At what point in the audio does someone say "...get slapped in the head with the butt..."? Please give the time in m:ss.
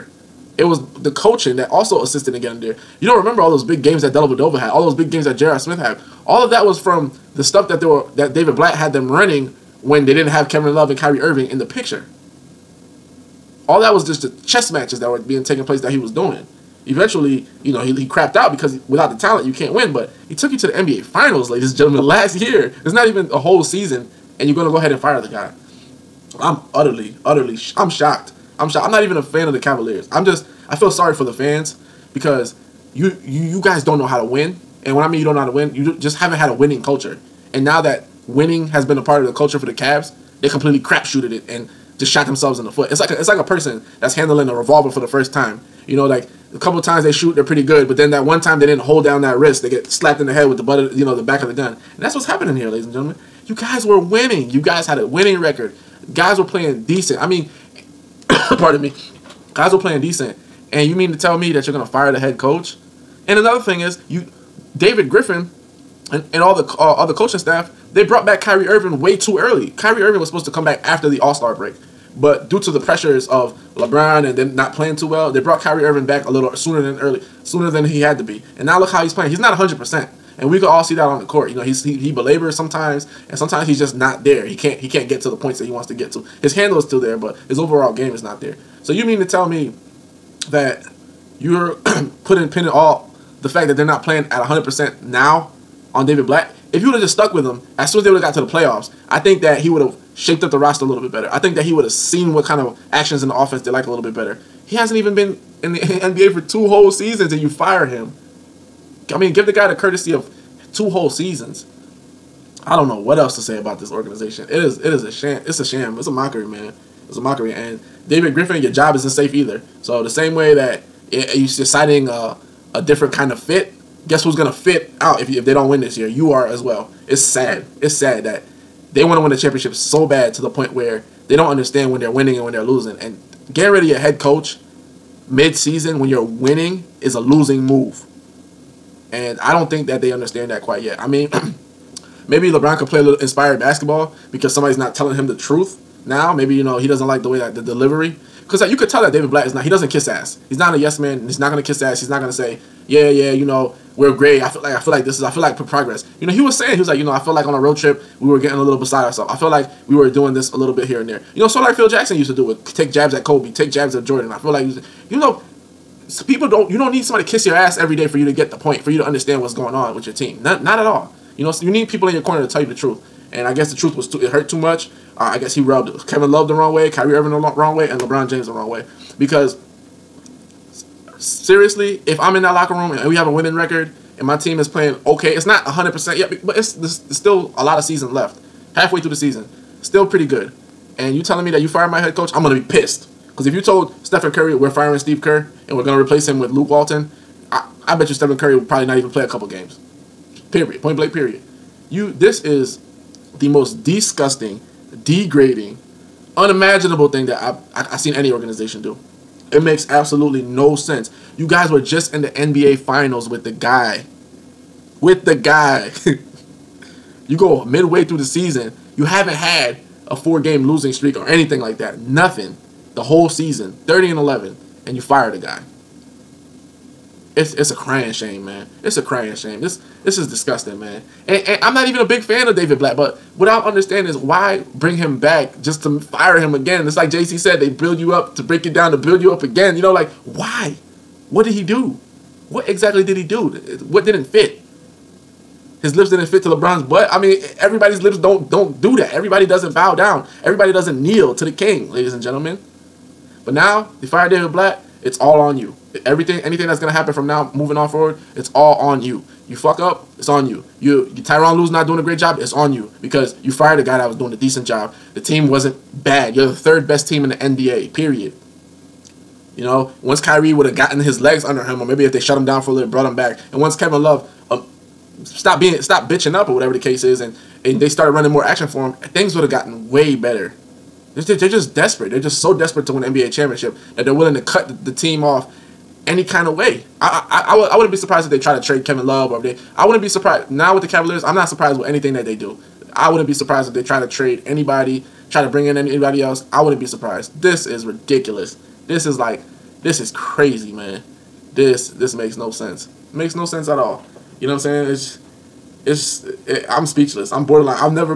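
0:49.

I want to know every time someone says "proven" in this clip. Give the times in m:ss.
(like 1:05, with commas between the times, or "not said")
not said.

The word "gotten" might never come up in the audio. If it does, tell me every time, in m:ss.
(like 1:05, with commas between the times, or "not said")
4:30, 4:39.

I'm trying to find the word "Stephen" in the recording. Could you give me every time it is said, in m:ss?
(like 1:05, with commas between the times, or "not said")
3:14, 3:18.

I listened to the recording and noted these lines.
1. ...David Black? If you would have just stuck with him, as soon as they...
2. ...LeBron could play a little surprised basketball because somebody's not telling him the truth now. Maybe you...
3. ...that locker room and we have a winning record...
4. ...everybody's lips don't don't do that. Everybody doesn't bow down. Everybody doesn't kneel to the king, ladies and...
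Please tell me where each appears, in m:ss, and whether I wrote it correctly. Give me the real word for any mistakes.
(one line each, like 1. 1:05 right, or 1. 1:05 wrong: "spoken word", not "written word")
1. 1:36 right
2. 2:22 wrong: "inspired", not "surprised"
3. 3:02 right
4. 4:07 right.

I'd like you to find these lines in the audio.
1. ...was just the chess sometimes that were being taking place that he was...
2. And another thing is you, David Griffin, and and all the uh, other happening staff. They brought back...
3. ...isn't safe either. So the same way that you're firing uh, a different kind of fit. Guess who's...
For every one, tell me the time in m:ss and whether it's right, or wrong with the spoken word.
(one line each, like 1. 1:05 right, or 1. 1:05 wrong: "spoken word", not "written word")
1. 0:13 wrong: "matches", not "sometimes"
2. 1:03 wrong: "coaching", not "happening"
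3. 1:58 wrong: "deciding", not "firing".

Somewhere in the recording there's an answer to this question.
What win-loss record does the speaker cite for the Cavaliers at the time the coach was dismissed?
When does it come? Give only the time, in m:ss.
3:43.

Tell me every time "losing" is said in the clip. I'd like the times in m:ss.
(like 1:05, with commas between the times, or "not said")
2:12, 2:17, 3:40.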